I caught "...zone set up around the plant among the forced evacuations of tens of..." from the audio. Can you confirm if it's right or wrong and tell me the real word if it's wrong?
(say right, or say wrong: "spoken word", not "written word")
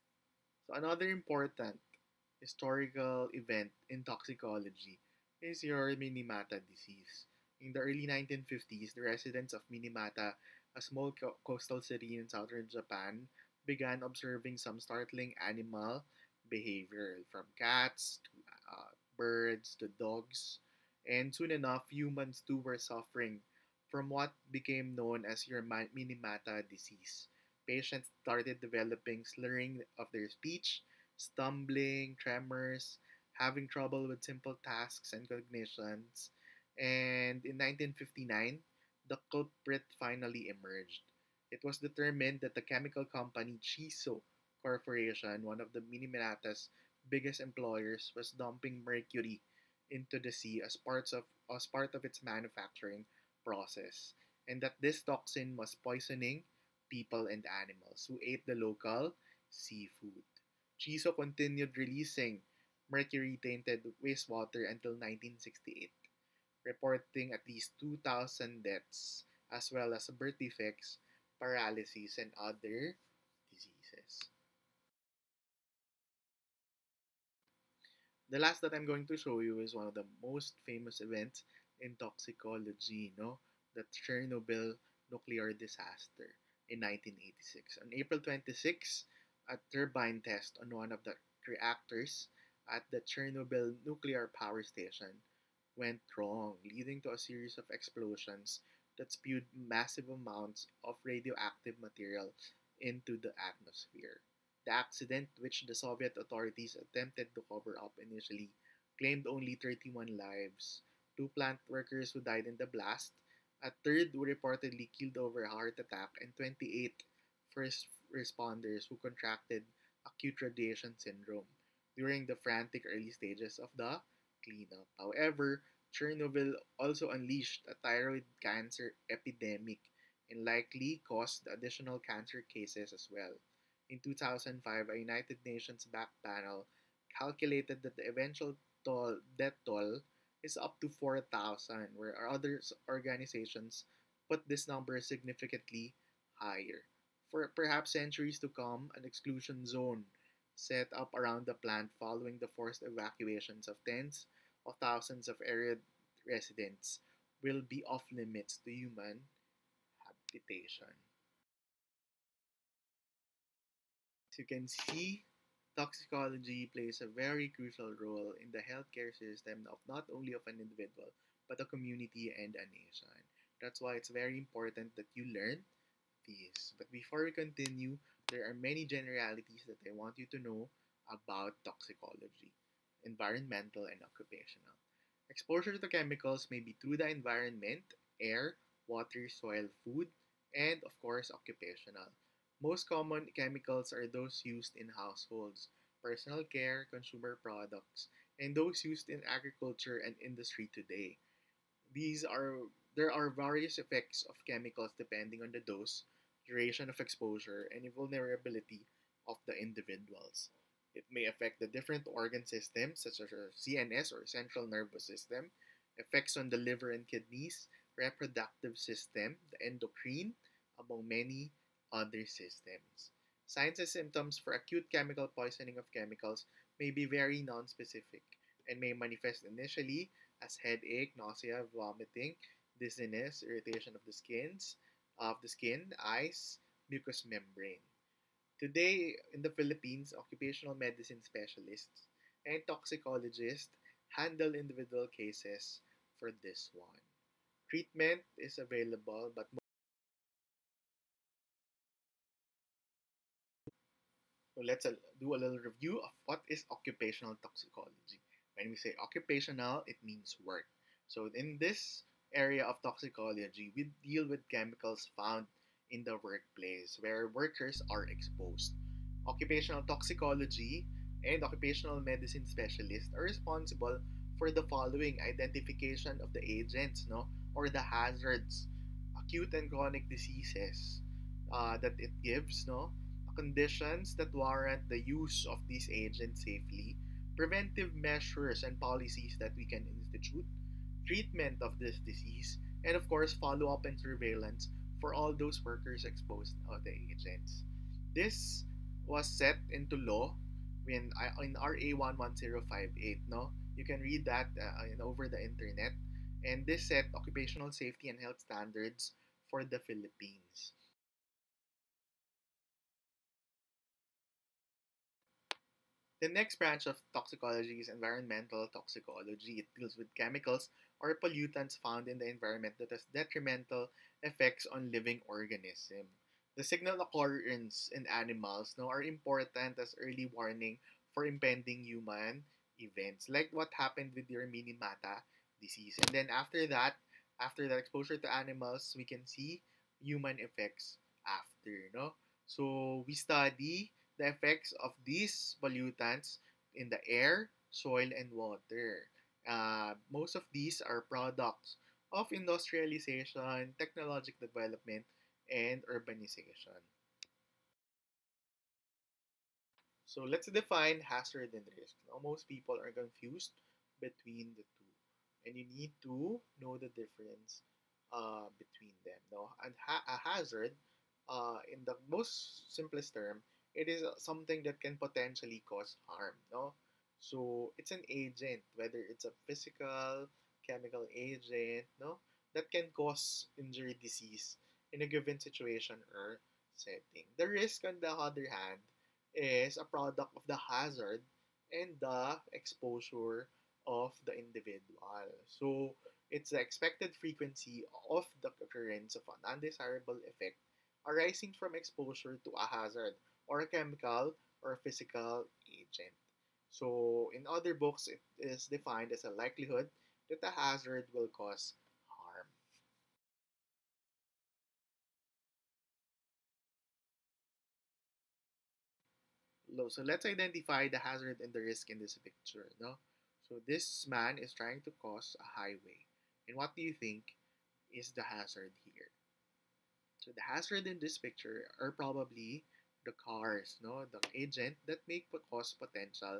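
wrong: "following", not "among".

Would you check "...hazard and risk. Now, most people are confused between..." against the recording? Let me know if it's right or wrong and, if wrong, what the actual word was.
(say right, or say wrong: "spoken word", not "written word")
right.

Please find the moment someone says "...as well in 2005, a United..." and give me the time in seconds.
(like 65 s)
132 s.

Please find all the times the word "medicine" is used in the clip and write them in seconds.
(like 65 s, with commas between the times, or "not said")
240 s, 272 s.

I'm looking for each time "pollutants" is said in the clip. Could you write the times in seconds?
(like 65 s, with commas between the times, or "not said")
321 s, 345 s.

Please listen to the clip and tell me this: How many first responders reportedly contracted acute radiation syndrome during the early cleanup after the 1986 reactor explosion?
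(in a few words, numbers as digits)
28.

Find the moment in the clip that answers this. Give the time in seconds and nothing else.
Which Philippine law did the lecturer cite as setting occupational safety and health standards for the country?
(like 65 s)
301 s.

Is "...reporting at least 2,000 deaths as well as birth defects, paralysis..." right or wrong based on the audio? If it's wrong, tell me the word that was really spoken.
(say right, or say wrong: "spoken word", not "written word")
right.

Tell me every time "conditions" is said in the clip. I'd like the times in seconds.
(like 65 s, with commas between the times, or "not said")
283 s.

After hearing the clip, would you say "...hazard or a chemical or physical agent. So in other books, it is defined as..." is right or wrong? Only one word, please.
right.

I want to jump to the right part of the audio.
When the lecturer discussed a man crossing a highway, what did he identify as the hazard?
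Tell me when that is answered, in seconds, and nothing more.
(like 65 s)
433 s.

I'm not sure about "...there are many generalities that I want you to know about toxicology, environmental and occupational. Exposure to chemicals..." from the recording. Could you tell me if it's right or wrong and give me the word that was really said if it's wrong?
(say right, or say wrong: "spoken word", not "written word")
right.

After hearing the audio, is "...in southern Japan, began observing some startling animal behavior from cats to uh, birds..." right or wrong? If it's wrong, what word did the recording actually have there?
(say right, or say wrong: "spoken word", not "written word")
right.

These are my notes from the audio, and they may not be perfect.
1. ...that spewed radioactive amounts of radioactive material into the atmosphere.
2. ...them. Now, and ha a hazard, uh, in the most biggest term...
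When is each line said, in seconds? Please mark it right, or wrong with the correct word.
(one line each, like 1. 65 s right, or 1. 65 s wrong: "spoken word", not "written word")
1. 98 s wrong: "massive", not "radioactive"
2. 369 s wrong: "simplest", not "biggest".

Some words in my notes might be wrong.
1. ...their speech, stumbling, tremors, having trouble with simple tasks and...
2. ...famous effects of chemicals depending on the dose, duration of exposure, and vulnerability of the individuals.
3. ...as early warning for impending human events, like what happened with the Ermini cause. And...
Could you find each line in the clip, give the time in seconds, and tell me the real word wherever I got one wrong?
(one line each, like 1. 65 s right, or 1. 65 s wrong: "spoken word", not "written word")
1. 30 s right
2. 203 s wrong: "various", not "famous"
3. 329 s wrong: "disease", not "cause".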